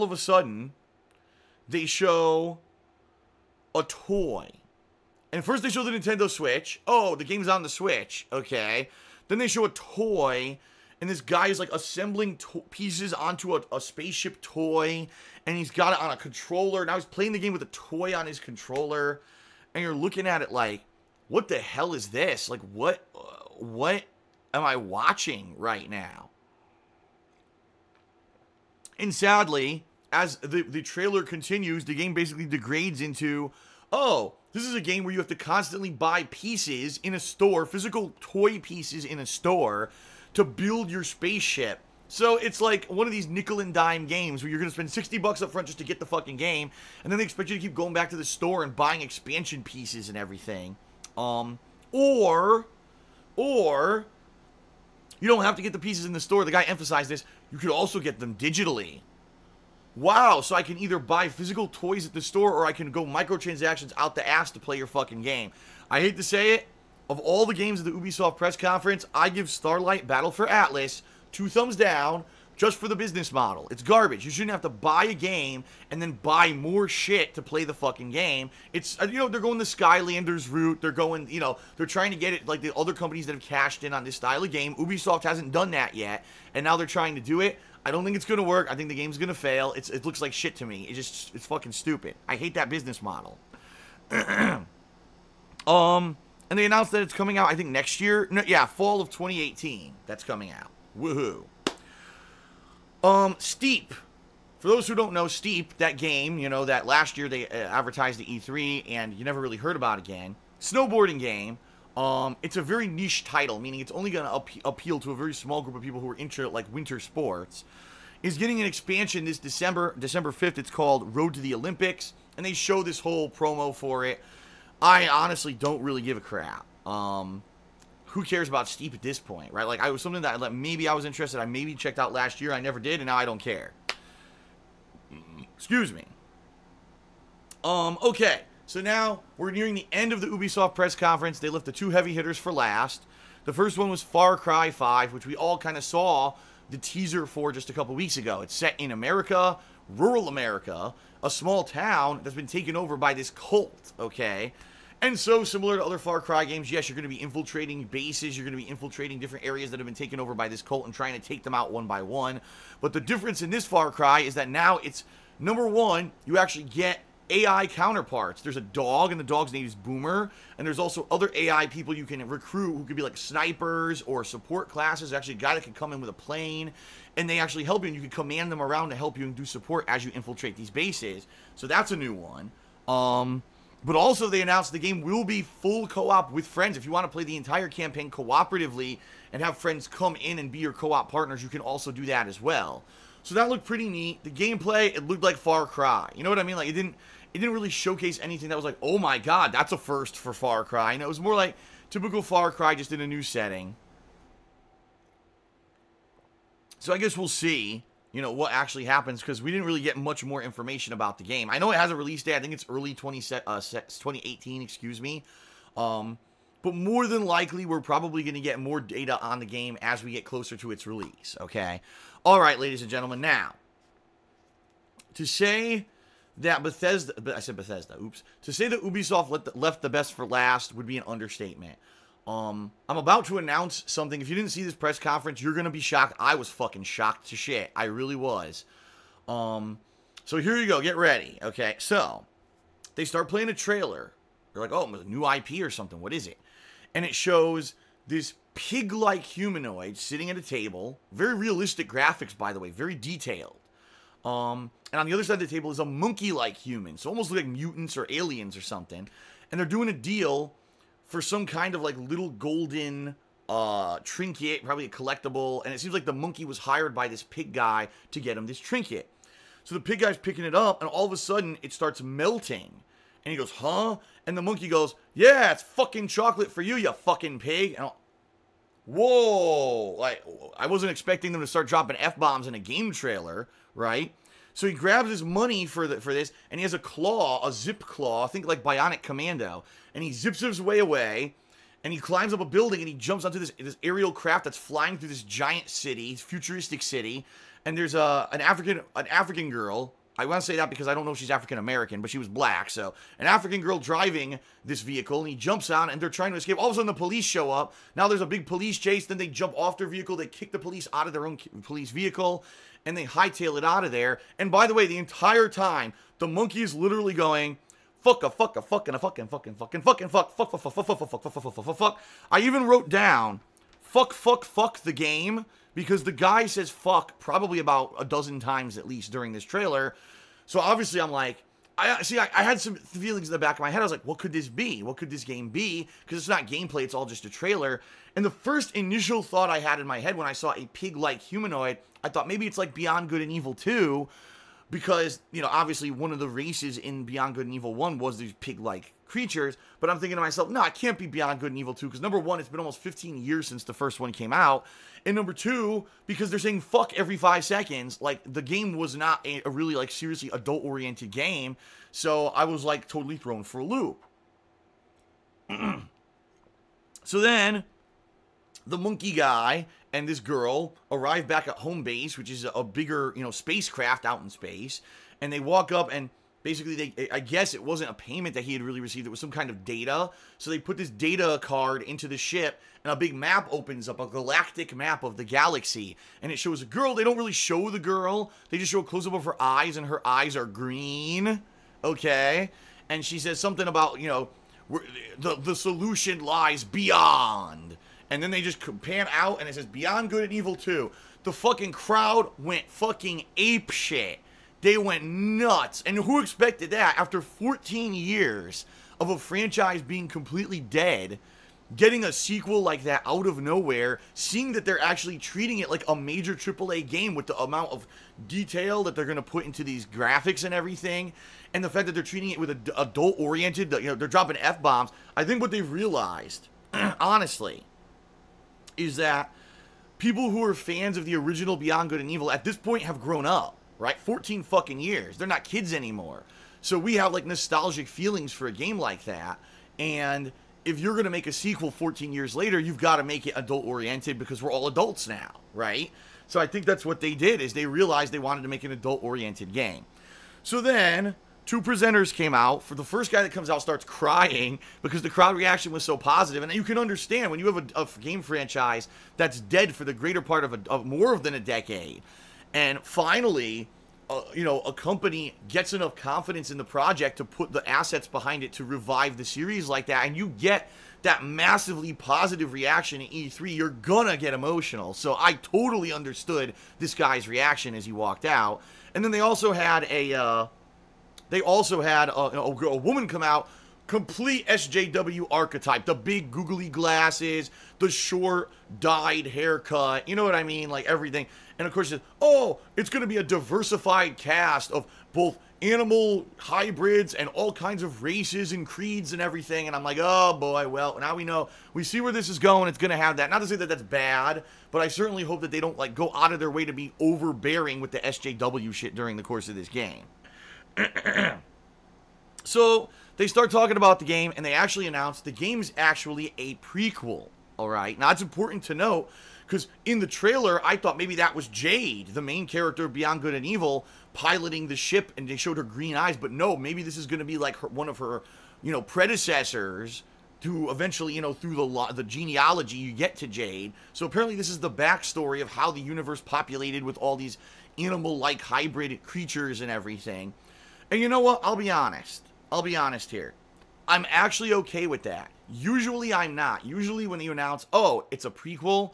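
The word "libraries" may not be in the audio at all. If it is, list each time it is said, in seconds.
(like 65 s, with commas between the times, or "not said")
not said.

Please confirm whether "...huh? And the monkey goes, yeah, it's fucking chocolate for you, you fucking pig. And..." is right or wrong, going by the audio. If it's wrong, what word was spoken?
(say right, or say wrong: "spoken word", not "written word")
right.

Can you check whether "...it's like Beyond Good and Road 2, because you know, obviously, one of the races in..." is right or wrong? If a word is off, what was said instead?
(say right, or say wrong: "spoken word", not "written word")
wrong: "Evil", not "Road".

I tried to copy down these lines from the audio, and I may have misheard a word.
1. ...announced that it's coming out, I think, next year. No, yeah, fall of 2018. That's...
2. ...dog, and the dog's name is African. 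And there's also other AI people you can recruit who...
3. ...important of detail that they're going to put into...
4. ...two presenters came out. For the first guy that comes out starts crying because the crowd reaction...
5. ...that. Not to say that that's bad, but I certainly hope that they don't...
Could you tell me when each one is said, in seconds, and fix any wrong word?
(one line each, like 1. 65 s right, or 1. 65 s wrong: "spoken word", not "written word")
1. 96 s right
2. 168 s wrong: "Boomer", not "African"
3. 417 s wrong: "amount", not "important"
4. 451 s right
5. 503 s right.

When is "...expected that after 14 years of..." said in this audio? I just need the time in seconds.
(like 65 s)
406 s.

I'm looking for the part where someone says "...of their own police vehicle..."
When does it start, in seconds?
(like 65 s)
311 s.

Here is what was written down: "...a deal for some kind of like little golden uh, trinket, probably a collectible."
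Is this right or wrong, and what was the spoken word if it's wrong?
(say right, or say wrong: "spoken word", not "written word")
right.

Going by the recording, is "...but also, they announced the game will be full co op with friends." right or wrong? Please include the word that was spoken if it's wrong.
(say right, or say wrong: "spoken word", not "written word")
right.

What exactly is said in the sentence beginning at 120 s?
It's called Road to the Olympics, and they show this whole promo for it I honestly don't really give a crap.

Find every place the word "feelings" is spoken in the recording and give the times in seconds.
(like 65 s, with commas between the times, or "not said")
332 s, 437 s.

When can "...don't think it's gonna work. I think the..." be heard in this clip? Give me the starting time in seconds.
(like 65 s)
87 s.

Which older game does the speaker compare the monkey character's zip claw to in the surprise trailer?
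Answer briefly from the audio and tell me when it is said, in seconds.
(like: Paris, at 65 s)
Bionic Commando, at 288 s.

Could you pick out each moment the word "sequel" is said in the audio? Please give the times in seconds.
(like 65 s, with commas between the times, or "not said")
412 s, 441 s.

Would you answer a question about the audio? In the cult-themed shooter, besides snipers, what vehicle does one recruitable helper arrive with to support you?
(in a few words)
a plane.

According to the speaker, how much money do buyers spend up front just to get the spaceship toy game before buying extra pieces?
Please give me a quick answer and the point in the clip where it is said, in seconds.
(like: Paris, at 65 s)
60 bucks, at 44 s.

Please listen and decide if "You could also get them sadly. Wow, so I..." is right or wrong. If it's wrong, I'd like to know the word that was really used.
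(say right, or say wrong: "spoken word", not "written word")
wrong: "digitally", not "sadly".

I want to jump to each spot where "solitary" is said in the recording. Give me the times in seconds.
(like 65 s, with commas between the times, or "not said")
not said.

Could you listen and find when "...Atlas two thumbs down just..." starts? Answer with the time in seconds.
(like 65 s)
70 s.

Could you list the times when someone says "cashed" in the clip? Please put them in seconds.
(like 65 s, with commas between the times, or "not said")
83 s.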